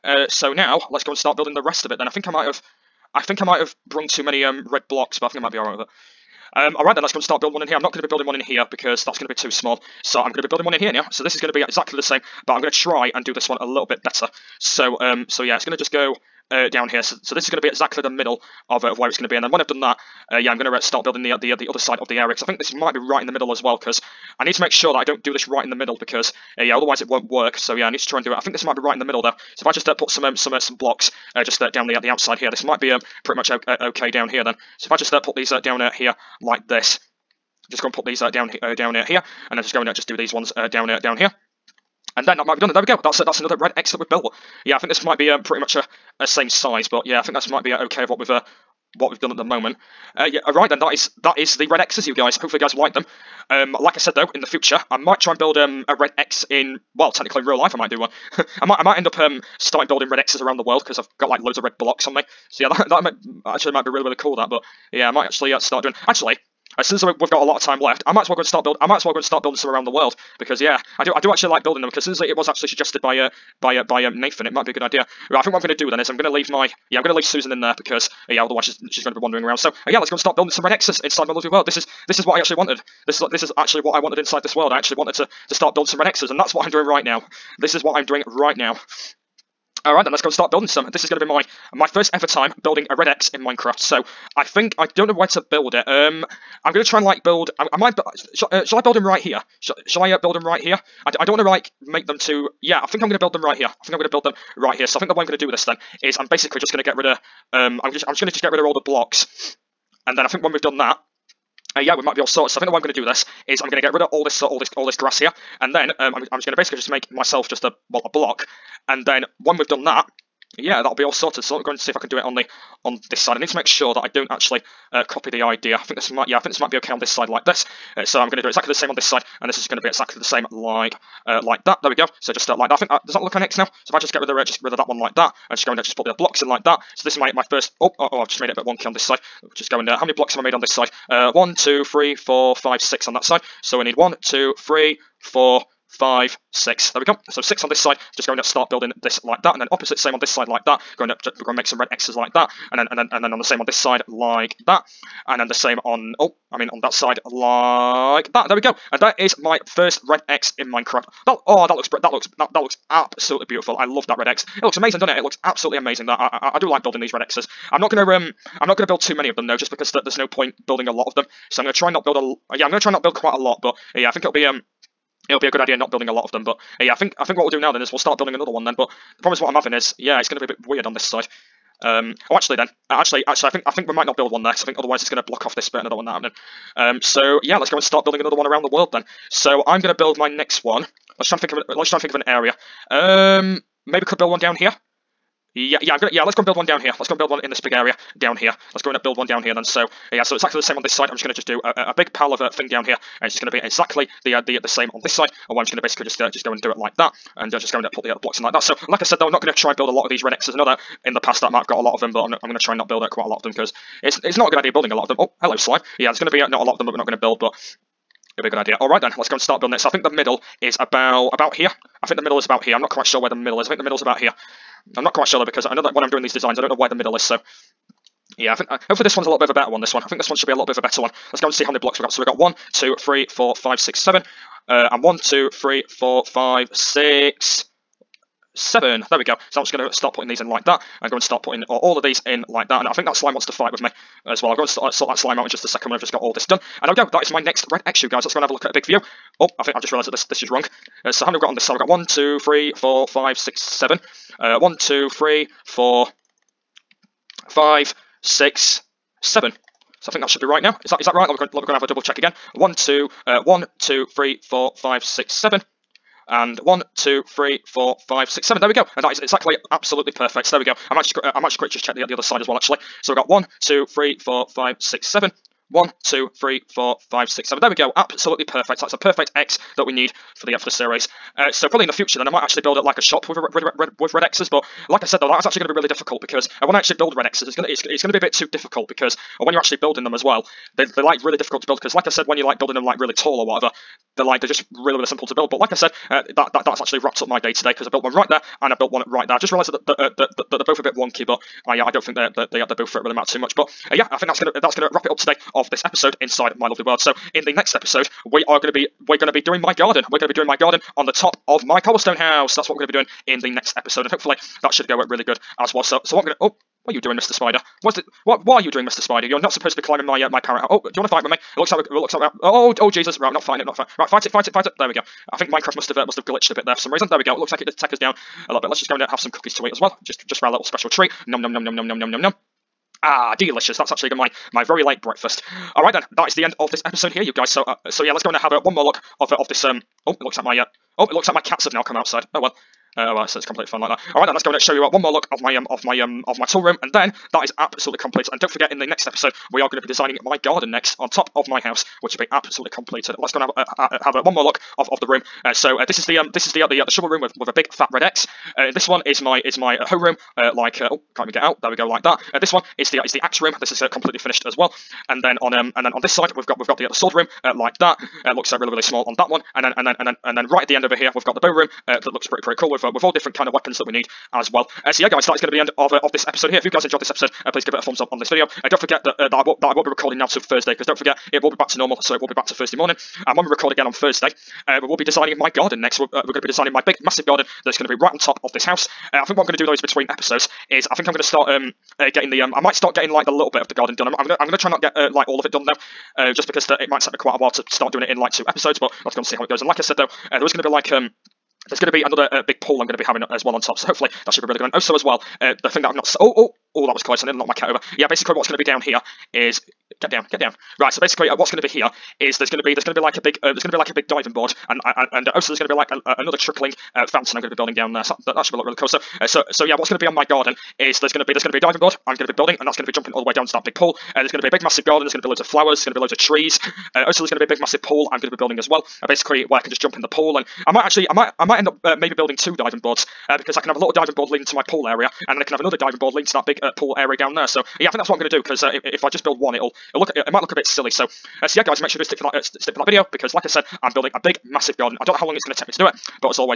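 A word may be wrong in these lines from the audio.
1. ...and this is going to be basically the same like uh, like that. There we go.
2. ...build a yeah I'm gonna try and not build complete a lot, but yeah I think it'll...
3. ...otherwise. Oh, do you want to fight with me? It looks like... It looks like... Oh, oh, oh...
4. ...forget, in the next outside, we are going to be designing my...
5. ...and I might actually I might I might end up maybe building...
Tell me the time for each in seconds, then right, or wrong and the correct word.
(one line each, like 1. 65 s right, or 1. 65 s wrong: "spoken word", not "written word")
1. 129 s wrong: "exactly", not "basically"
2. 172 s wrong: "quite", not "complete"
3. 320 s wrong: "house", not "otherwise"
4. 348 s wrong: "episode", not "outside"
5. 430 s right.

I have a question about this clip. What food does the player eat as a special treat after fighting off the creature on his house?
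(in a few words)
cookies.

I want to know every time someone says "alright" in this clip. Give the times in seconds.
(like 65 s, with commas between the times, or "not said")
5 s, 89 s, 335 s.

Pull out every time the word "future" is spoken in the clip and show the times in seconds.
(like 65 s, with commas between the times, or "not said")
54 s, 281 s.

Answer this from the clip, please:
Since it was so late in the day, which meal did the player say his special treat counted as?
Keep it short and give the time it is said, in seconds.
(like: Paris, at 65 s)
breakfast, at 334 s.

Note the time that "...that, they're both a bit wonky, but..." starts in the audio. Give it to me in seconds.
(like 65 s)
300 s.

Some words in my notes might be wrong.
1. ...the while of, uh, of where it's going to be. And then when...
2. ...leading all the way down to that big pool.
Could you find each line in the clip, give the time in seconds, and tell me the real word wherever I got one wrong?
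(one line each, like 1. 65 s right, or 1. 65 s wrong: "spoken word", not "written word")
1. 18 s wrong: "middle", not "while"
2. 422 s wrong: "jumping", not "leading".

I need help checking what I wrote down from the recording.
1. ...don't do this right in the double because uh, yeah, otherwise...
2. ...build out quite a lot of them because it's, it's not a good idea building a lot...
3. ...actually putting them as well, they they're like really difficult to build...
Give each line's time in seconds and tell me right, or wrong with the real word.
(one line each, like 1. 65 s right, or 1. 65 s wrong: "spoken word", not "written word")
1. 25 s wrong: "middle", not "double"
2. 212 s right
3. 289 s wrong: "building", not "putting".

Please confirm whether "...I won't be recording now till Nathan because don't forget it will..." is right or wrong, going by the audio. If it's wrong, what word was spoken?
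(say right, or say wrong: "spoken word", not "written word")
wrong: "Thursday", not "Nathan".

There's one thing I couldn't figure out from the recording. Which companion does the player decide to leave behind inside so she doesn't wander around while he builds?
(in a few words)
Susan.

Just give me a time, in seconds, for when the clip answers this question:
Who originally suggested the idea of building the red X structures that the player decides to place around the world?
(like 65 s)
74 s.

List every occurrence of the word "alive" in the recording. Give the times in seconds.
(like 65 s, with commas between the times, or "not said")
not said.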